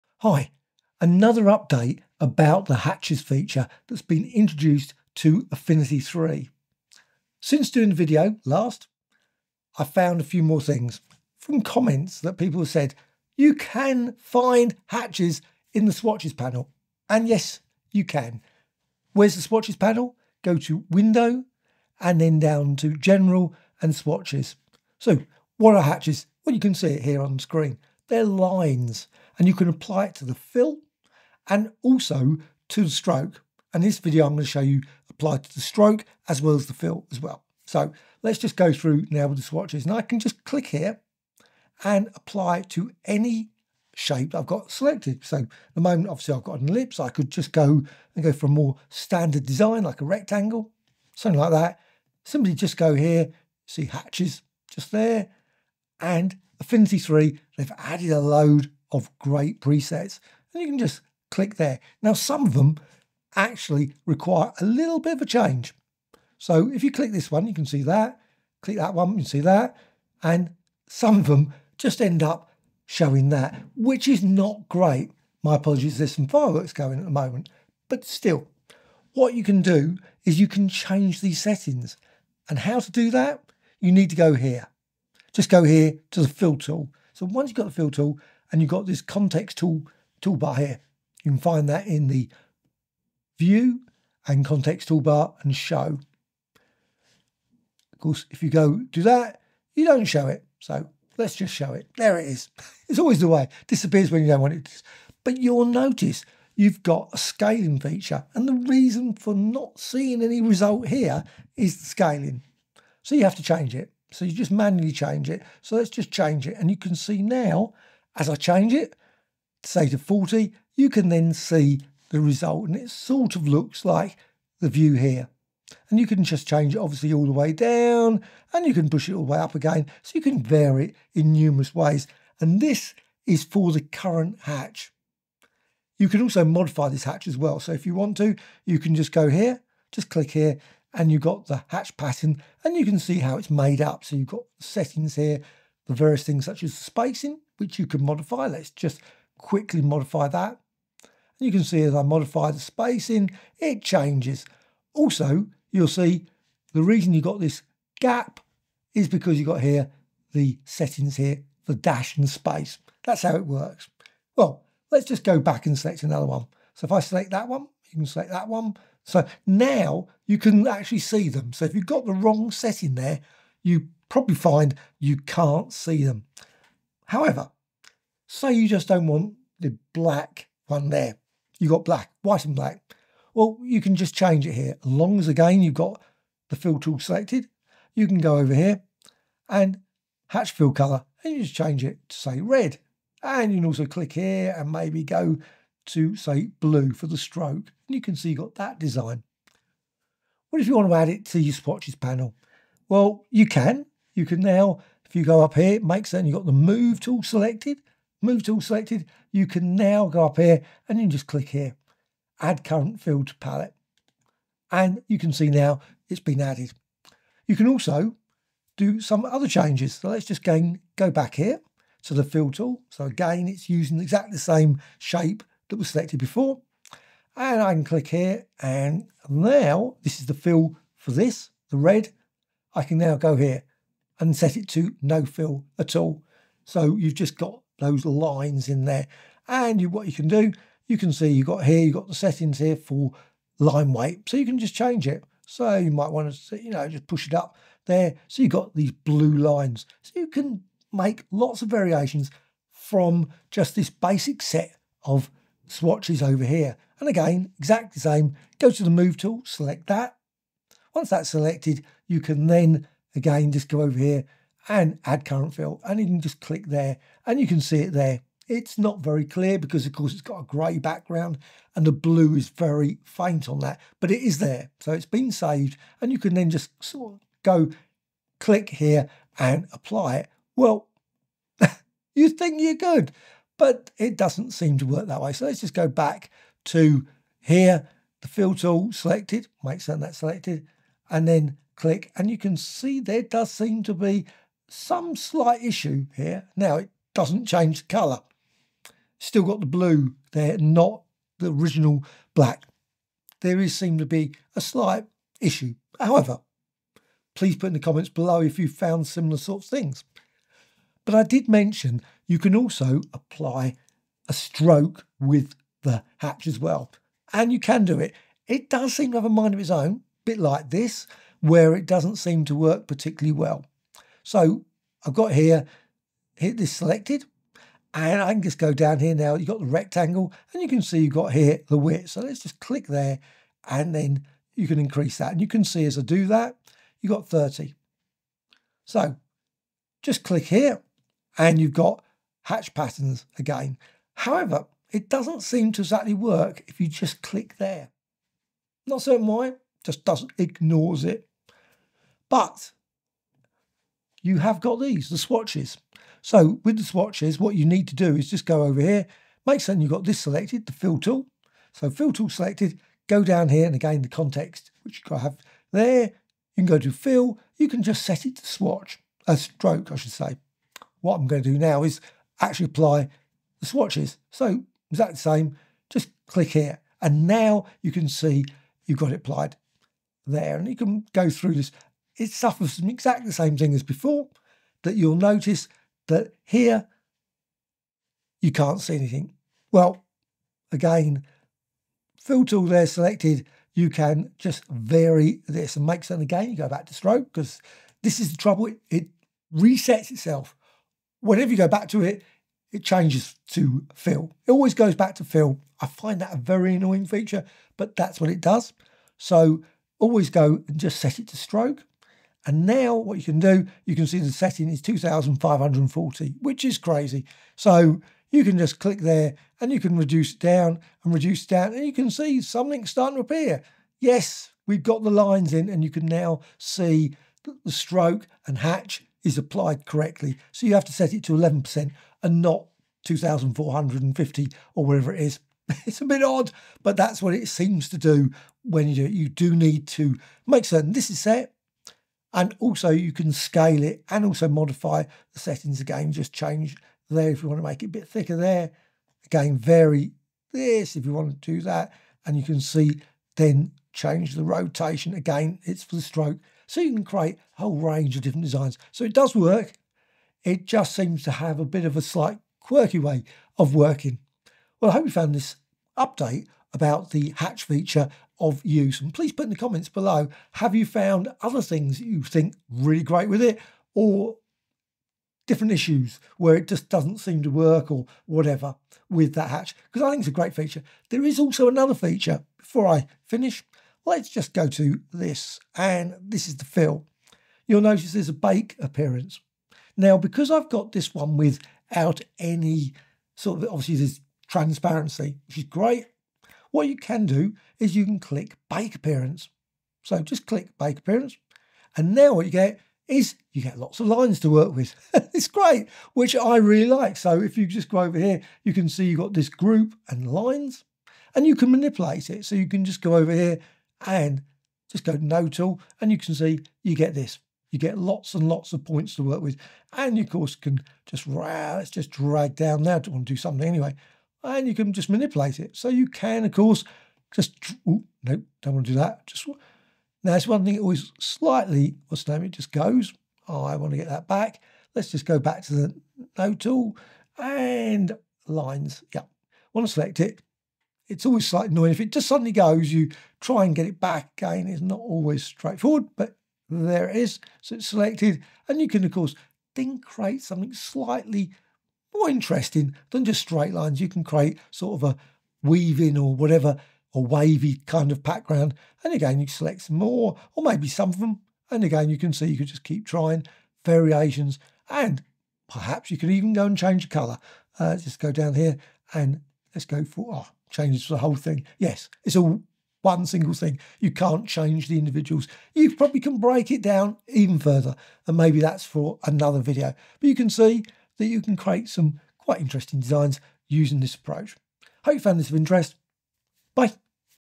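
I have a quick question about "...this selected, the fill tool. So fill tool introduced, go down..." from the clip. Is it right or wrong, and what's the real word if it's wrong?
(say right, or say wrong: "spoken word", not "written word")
wrong: "selected", not "introduced".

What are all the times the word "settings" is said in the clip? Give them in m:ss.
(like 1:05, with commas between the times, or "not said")
1:21, 2:24, 2:40, 2:52, 4:02, 6:54, 7:25.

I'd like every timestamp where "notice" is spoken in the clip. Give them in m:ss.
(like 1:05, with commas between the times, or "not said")
1:45, 6:25, 8:07.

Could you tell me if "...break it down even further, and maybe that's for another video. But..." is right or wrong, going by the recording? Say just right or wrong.
right.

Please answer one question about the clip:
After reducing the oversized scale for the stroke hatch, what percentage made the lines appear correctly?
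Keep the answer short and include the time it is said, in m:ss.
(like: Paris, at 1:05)
11%, at 7:11.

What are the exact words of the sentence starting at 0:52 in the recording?
Simply just go here, see hatches just there and Affinity 3, they've added a load of great presets.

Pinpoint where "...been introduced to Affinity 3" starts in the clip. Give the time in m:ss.
0:04.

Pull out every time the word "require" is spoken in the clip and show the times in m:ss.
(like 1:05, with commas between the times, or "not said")
1:04.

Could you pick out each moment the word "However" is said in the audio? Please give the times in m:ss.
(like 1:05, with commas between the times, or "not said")
2:57, 5:05, 5:44.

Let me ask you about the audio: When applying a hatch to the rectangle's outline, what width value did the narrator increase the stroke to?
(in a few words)
30.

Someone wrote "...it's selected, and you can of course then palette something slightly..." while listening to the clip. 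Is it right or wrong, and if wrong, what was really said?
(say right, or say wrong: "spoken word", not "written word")
wrong: "create", not "palette".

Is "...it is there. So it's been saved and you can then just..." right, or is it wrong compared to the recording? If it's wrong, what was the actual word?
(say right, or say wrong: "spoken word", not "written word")
right.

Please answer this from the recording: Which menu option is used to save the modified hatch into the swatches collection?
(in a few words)
Add current fill to palette.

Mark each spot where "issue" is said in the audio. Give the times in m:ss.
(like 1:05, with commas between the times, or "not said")
4:55, 5:05, 7:55.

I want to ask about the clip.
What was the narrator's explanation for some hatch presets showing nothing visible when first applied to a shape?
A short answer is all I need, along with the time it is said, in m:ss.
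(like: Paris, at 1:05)
The scaling, at 1:51.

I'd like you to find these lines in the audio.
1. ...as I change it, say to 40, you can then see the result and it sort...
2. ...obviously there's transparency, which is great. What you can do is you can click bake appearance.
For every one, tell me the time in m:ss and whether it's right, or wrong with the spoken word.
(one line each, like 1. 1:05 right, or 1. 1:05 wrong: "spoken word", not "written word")
1. 1:58 right
2. 8:13 right.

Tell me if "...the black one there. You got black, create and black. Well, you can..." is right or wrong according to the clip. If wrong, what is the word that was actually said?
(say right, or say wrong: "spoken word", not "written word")
wrong: "white", not "create".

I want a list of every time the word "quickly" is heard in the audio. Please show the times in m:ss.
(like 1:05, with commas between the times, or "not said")
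2:29.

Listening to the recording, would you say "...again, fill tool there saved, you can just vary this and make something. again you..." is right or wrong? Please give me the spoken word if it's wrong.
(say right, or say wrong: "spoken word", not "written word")
wrong: "selected", not "saved".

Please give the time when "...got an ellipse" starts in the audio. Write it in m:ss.
0:46.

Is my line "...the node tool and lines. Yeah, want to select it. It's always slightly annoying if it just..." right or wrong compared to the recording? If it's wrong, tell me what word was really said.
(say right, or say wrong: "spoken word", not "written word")
right.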